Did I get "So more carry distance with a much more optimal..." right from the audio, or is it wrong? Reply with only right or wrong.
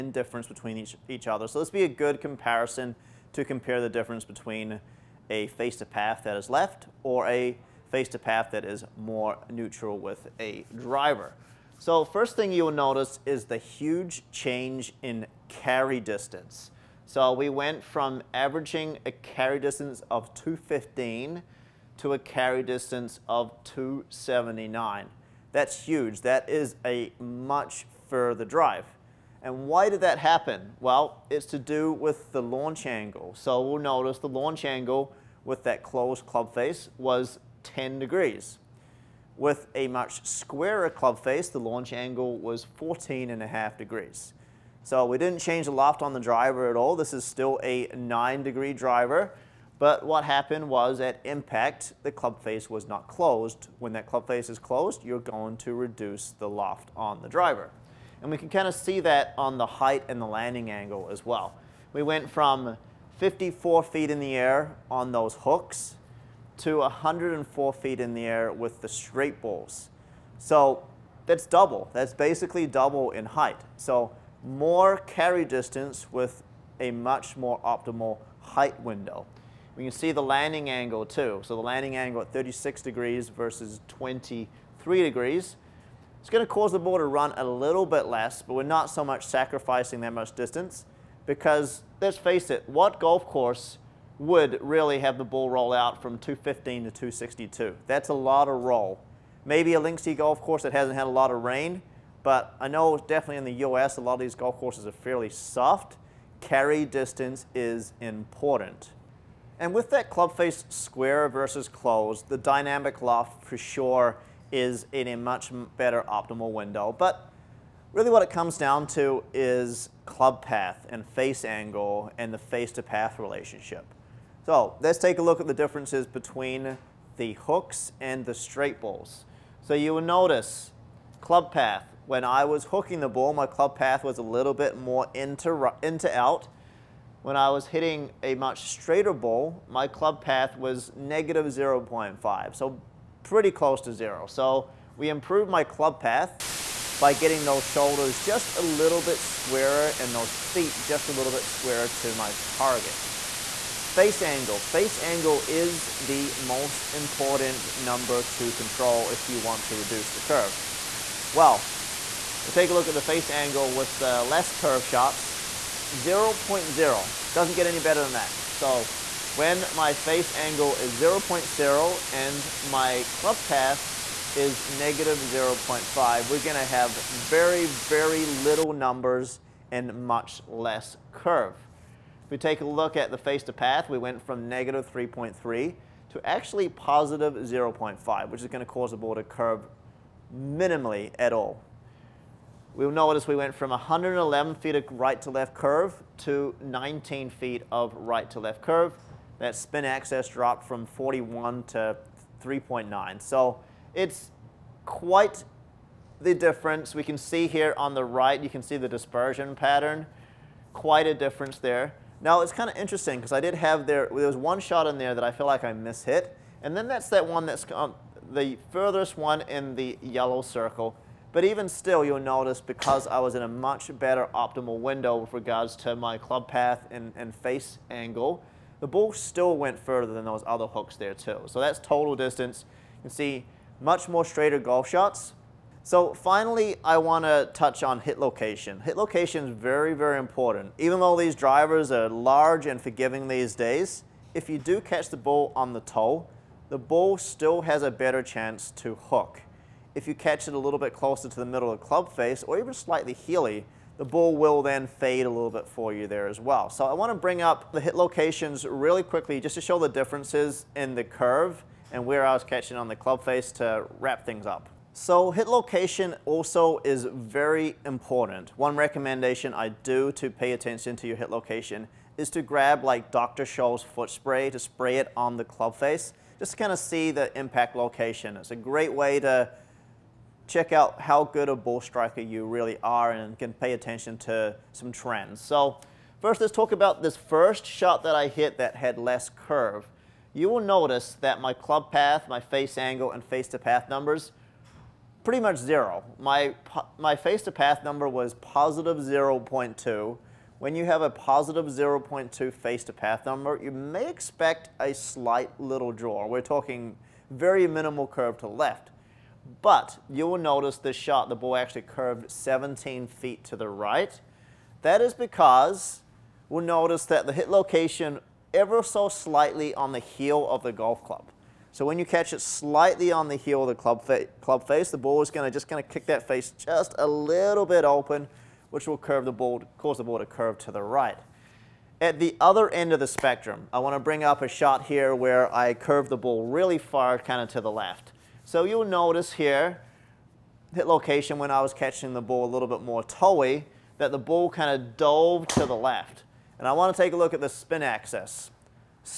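right.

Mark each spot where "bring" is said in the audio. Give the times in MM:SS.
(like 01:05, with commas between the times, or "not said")
04:17, 05:34.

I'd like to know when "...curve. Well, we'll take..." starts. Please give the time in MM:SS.
02:40.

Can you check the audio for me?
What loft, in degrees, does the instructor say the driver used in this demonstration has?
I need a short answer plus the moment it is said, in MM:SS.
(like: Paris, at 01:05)
9 degrees, at 00:47.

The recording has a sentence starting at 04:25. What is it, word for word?
So hit location also is very important.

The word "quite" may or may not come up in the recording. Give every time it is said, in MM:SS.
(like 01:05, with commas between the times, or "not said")
03:24, 03:30.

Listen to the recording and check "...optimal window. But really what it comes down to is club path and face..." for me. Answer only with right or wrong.
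right.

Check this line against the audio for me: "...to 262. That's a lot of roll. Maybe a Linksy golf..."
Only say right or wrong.
right.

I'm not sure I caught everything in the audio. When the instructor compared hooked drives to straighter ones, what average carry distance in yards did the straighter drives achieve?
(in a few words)
279.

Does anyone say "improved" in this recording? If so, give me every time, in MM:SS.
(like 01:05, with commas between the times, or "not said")
02:25.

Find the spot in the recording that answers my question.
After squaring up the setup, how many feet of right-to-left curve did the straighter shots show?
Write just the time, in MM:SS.
03:16.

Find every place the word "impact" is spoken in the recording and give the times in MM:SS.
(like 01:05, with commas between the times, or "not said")
00:51, 04:37.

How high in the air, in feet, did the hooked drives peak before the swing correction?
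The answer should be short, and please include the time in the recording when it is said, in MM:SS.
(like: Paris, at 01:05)
54 feet, at 01:03.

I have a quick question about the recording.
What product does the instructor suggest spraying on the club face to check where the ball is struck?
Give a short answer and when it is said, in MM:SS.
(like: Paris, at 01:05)
Dr. Scholl's foot spray, at 04:33.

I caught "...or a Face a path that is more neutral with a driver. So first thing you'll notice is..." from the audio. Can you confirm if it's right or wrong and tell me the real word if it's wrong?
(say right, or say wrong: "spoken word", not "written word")
right.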